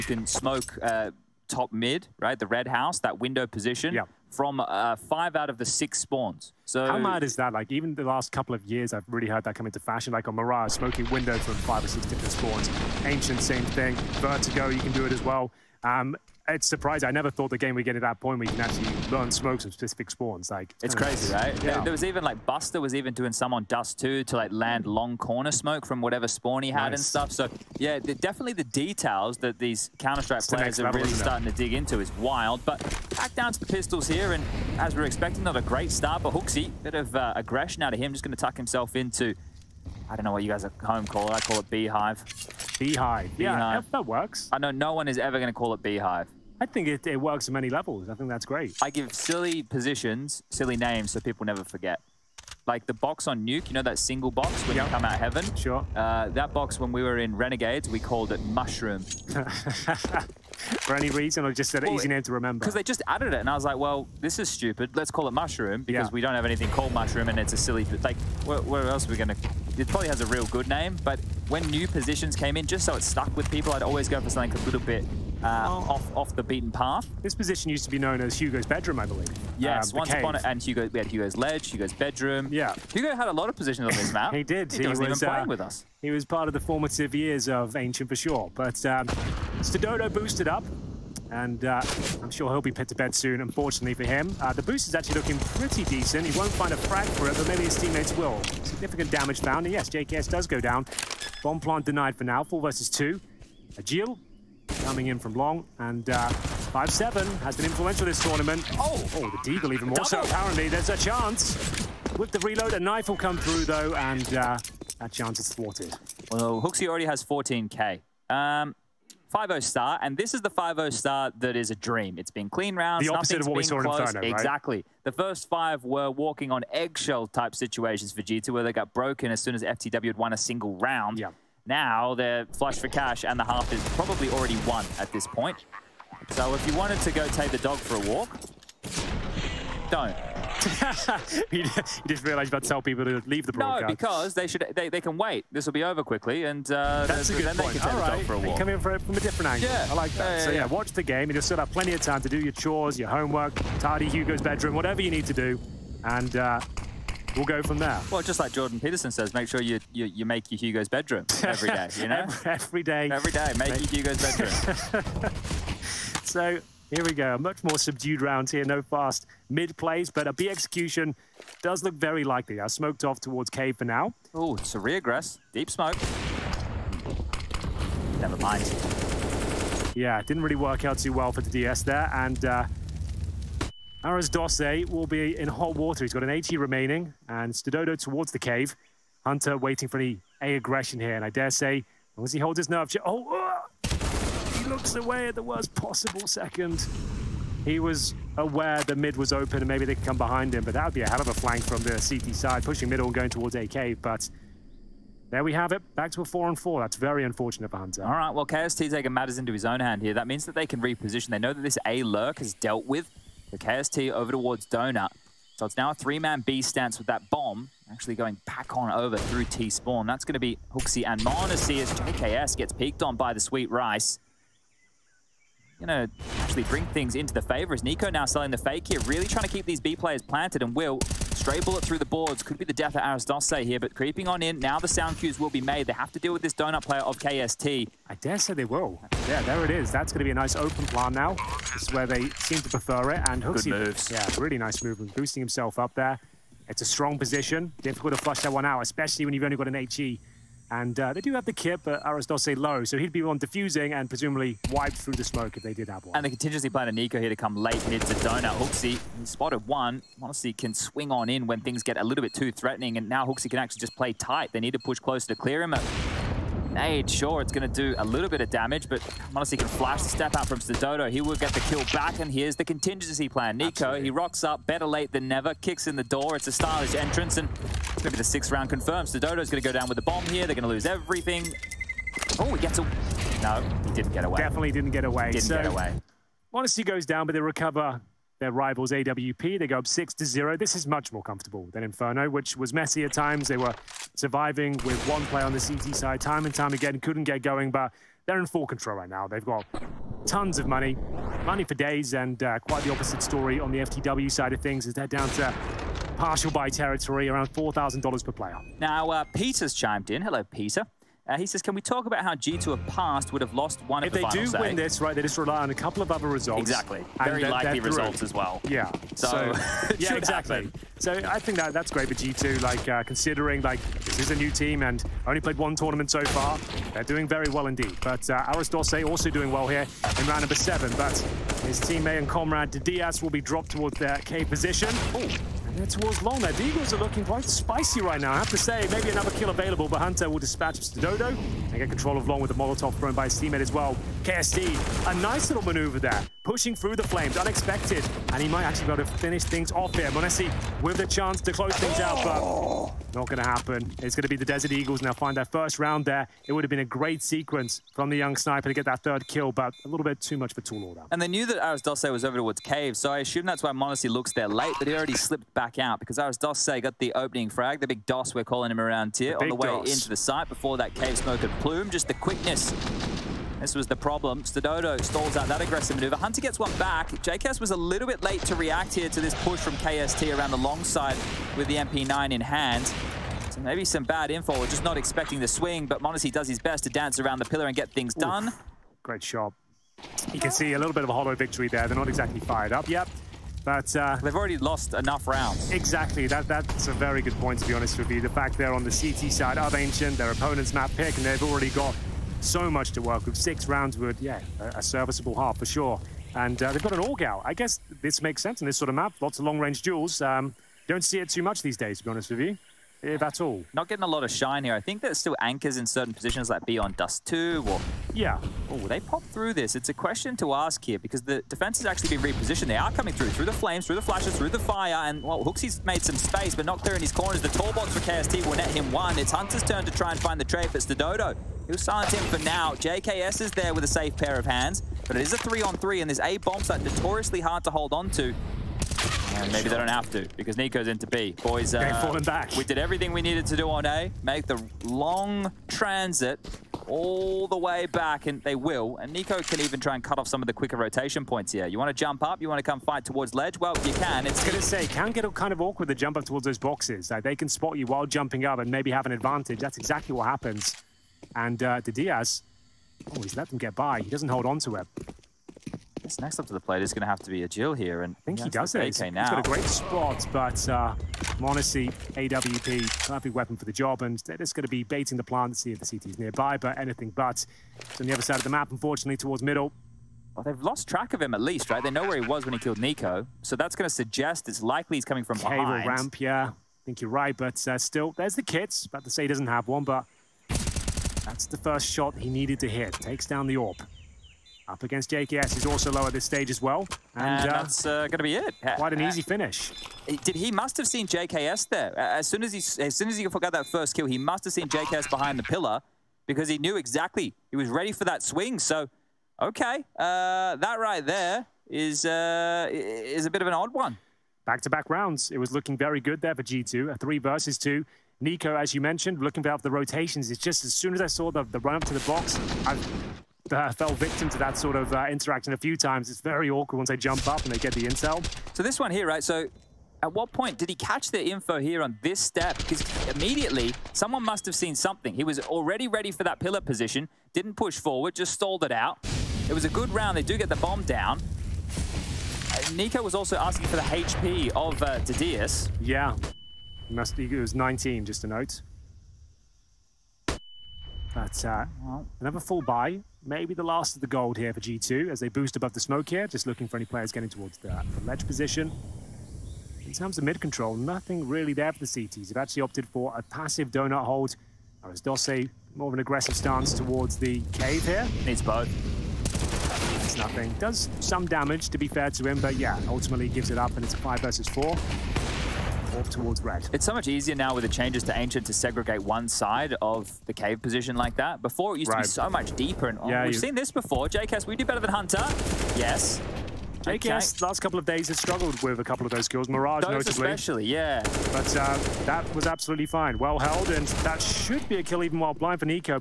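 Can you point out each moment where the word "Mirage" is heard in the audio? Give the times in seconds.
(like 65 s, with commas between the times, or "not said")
10 s, 589 s.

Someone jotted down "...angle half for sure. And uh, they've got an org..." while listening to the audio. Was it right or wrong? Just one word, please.
wrong.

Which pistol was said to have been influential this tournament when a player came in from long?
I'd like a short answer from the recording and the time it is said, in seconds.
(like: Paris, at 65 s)
5-7, at 106 s.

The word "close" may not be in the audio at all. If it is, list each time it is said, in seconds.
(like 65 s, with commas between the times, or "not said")
264 s, 351 s.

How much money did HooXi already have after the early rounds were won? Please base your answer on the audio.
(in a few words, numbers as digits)
14k.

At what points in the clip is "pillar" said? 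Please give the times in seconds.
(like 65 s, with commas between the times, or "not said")
387 s, 505 s, 536 s.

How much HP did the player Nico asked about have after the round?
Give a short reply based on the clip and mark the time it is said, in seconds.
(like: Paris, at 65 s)
19, at 547 s.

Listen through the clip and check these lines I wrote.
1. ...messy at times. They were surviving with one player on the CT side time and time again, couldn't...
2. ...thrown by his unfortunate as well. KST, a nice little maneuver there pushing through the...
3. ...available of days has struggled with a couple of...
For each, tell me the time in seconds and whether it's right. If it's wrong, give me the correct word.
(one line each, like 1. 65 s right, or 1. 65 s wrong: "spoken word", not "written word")
1. 292 s right
2. 342 s wrong: "teammate", not "unfortunate"
3. 587 s wrong: "couple", not "available".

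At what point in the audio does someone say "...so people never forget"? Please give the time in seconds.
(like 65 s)
51 s.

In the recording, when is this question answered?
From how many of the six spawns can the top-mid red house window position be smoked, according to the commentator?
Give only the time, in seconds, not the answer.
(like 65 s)
4 s.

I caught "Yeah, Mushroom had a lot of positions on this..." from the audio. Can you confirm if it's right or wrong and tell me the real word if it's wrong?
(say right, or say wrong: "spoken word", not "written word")
wrong: "Hugo", not "Mushroom".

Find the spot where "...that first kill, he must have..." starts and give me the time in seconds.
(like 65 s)
503 s.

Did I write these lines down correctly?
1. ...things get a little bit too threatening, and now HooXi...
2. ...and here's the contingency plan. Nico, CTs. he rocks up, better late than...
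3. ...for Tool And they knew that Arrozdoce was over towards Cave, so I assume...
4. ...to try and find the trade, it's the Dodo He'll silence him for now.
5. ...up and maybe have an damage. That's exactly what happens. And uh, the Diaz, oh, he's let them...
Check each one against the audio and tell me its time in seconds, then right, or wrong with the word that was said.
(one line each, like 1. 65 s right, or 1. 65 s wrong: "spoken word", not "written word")
1. 261 s right
2. 272 s wrong: "Absolutely", not "CTs"
3. 360 s right
4. 429 s right
5. 458 s wrong: "advantage", not "damage".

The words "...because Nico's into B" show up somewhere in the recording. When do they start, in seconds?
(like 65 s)
440 s.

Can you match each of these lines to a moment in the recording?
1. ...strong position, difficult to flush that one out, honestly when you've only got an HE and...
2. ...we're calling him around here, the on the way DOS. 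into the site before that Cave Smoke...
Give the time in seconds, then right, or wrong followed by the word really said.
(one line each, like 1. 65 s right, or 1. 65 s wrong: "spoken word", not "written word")
1. 246 s wrong: "especially", not "honestly"
2. 368 s right.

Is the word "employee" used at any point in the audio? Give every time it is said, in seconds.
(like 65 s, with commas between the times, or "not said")
not said.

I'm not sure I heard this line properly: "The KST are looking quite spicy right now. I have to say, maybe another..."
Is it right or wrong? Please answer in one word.
wrong.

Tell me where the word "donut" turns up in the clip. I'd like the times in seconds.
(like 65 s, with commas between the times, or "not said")
214 s, 236 s, 258 s, 563 s.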